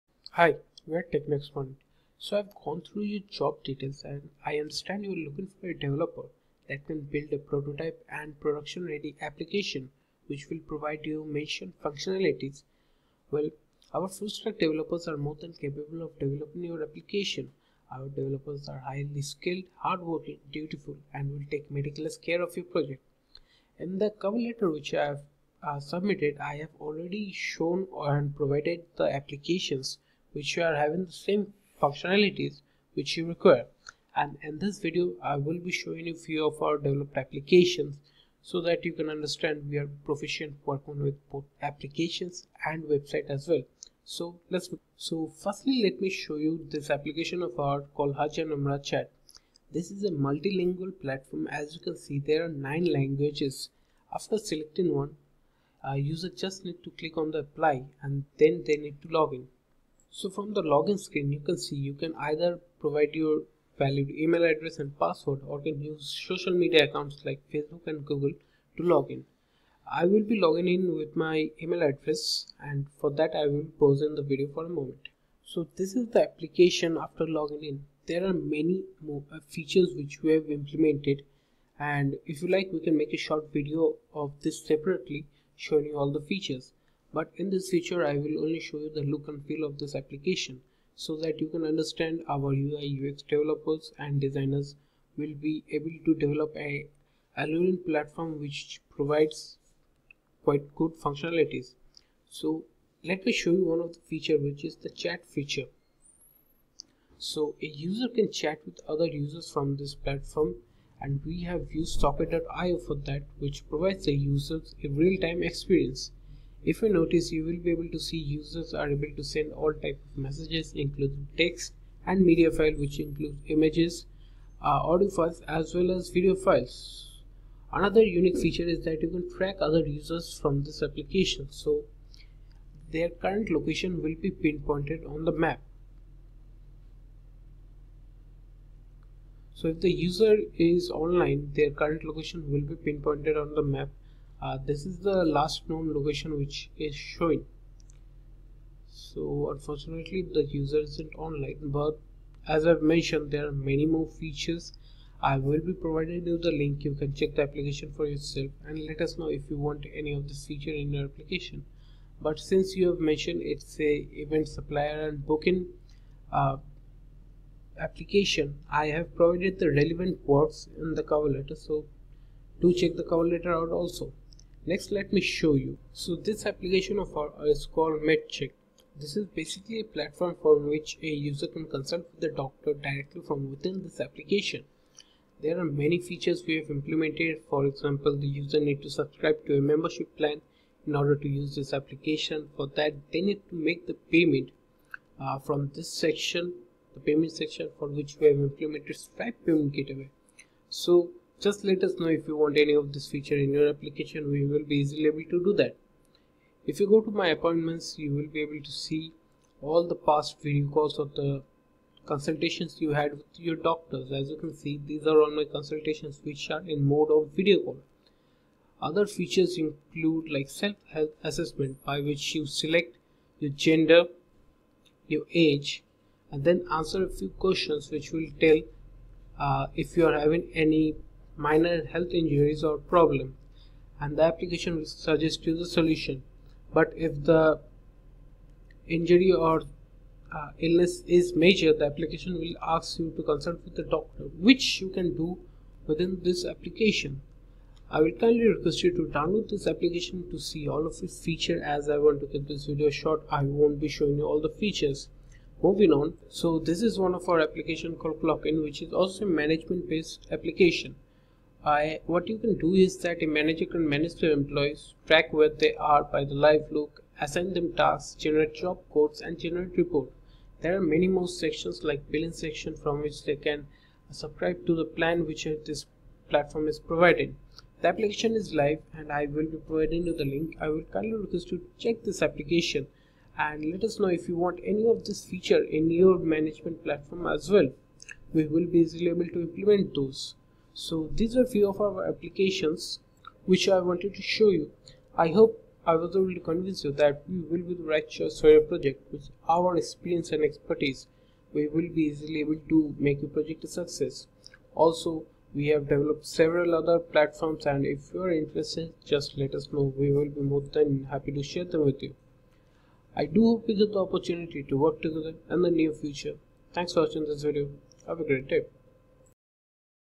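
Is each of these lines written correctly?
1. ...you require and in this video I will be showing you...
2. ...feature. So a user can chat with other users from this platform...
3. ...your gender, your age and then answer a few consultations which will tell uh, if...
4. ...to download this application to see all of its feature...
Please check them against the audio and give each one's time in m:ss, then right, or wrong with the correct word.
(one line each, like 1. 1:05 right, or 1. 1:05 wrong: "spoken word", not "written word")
1. 0:33 right
2. 1:45 right
3. 3:43 wrong: "questions", not "consultations"
4. 4:08 right.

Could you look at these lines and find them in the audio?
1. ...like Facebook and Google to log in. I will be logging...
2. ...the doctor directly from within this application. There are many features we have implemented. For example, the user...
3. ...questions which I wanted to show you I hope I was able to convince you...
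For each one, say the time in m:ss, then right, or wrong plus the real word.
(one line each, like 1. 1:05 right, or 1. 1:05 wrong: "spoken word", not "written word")
1. 1:07 right
2. 3:02 right
3. 4:52 wrong: "applications", not "questions".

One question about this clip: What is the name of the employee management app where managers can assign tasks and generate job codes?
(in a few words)
Clockin.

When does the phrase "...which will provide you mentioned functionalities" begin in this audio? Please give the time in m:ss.
0:10.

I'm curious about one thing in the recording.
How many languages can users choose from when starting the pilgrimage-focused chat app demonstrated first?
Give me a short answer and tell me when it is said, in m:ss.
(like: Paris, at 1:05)
9, at 0:52.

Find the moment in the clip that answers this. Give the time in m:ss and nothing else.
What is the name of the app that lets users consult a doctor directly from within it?
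2:58.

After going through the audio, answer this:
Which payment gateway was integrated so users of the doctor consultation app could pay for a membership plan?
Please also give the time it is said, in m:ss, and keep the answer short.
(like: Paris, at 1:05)
Stripe, at 3:18.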